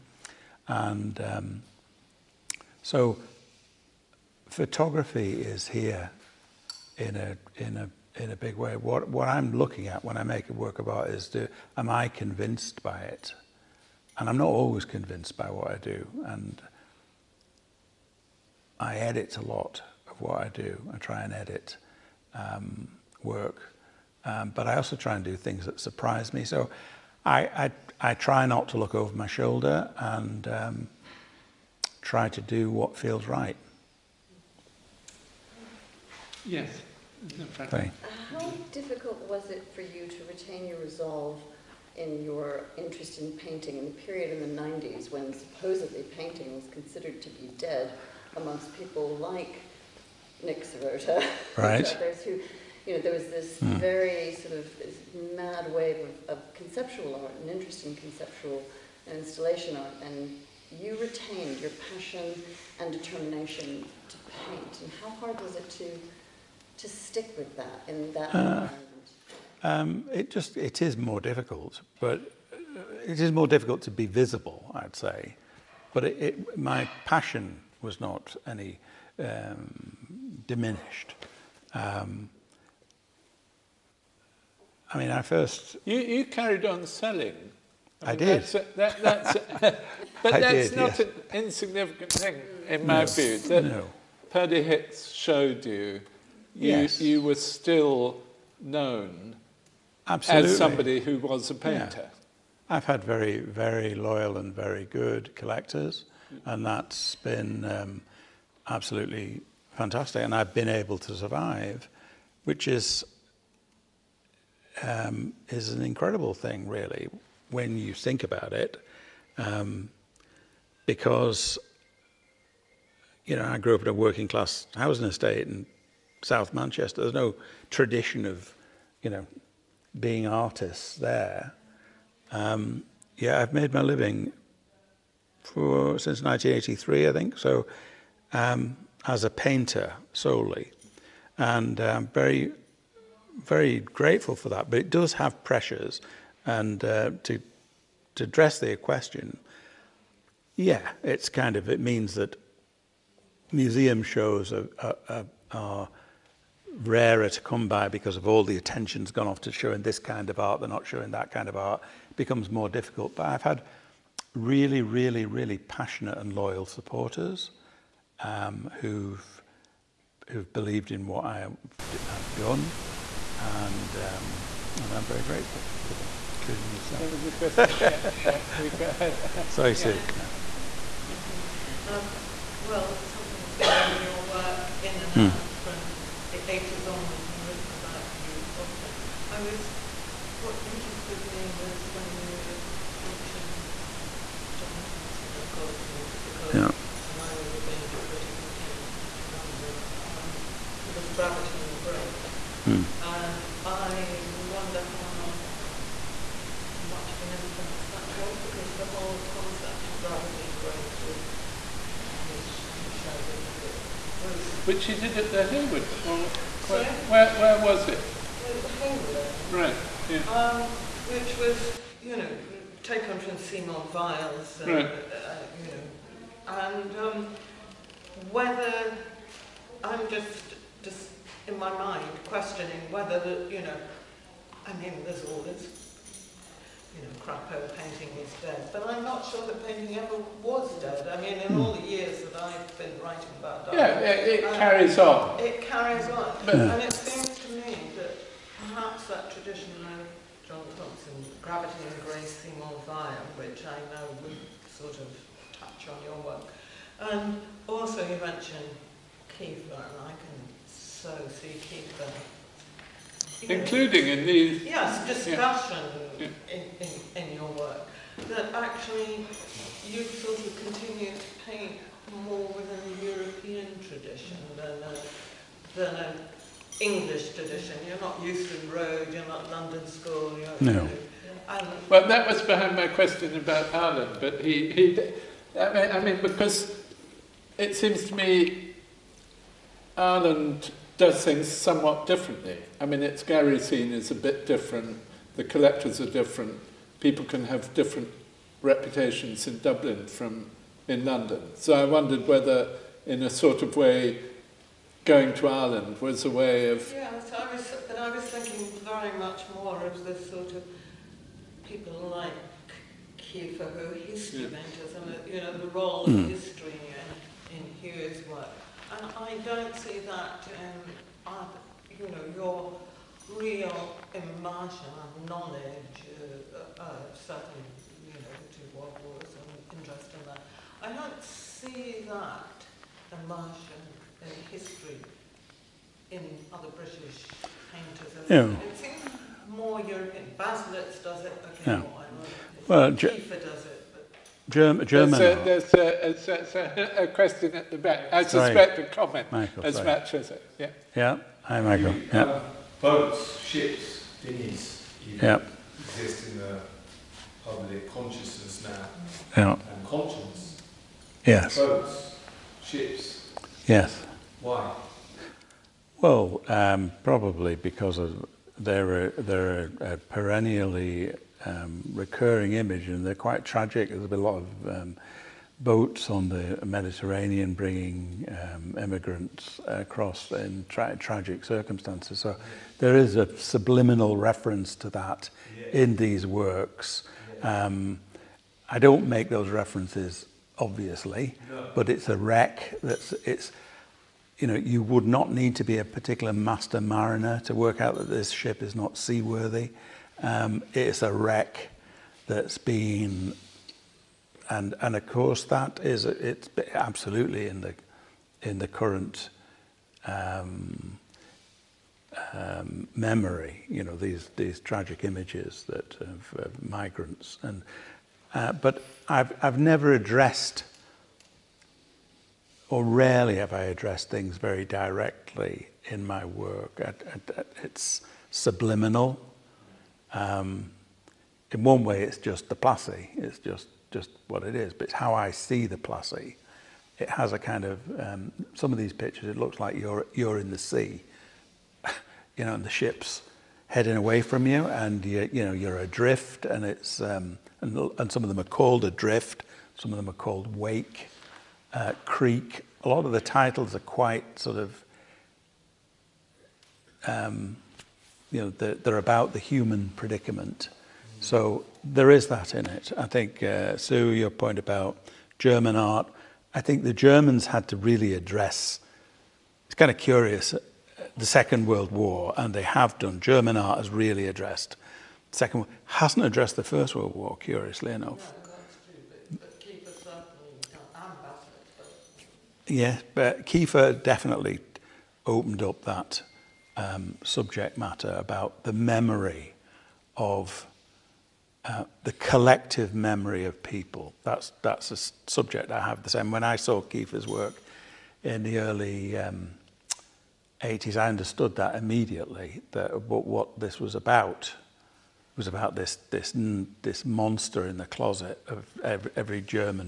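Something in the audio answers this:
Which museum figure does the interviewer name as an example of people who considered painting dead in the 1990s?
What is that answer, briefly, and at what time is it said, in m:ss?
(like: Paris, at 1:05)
Nick Serota, at 0:50.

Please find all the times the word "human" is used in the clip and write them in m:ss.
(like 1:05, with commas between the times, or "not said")
7:39.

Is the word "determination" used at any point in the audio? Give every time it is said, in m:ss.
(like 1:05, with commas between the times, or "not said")
1:02.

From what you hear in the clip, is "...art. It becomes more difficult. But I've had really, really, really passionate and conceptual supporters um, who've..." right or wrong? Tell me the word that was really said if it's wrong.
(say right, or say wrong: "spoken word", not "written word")
wrong: "loyal", not "conceptual".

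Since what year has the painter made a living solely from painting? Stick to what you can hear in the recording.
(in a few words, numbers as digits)
1983.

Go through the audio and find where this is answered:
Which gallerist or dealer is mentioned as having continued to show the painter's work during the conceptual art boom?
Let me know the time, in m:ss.
1:34.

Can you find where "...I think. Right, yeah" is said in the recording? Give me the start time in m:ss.
3:39.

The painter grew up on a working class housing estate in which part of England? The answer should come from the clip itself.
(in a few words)
South Manchester.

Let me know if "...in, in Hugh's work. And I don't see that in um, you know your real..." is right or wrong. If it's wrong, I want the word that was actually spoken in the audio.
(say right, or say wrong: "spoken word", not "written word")
right.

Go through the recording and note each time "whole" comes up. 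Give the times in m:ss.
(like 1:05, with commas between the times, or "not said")
3:28.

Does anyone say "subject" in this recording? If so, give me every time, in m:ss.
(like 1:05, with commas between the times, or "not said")
8:07, 8:15.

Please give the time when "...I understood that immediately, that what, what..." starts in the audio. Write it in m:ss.
8:20.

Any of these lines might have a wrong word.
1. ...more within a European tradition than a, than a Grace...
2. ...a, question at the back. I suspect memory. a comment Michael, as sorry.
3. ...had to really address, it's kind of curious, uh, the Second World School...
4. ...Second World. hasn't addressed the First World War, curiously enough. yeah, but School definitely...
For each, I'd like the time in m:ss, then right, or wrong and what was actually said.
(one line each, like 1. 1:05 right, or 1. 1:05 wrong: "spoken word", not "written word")
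1. 4:32 wrong: "English", not "Grace"
2. 5:47 wrong: "sorry", not "memory"
3. 7:47 wrong: "War", not "School"
4. 7:55 wrong: "Kiefer", not "School".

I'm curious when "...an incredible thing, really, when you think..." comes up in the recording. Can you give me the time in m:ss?
1:55.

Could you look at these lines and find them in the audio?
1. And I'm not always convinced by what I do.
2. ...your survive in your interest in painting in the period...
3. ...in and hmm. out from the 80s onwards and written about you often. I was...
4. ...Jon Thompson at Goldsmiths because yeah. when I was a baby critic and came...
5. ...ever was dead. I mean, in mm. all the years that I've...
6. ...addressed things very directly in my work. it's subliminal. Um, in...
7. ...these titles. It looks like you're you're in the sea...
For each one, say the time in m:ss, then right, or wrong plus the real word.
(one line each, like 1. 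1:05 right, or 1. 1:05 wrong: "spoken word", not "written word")
1. 0:14 right
2. 0:40 wrong: "resolve", not "survive"
3. 3:04 right
4. 3:14 right
5. 3:59 right
6. 7:03 right
7. 7:18 wrong: "pictures", not "titles".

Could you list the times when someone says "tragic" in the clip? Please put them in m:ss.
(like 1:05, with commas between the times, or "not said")
6:13, 6:20, 6:54.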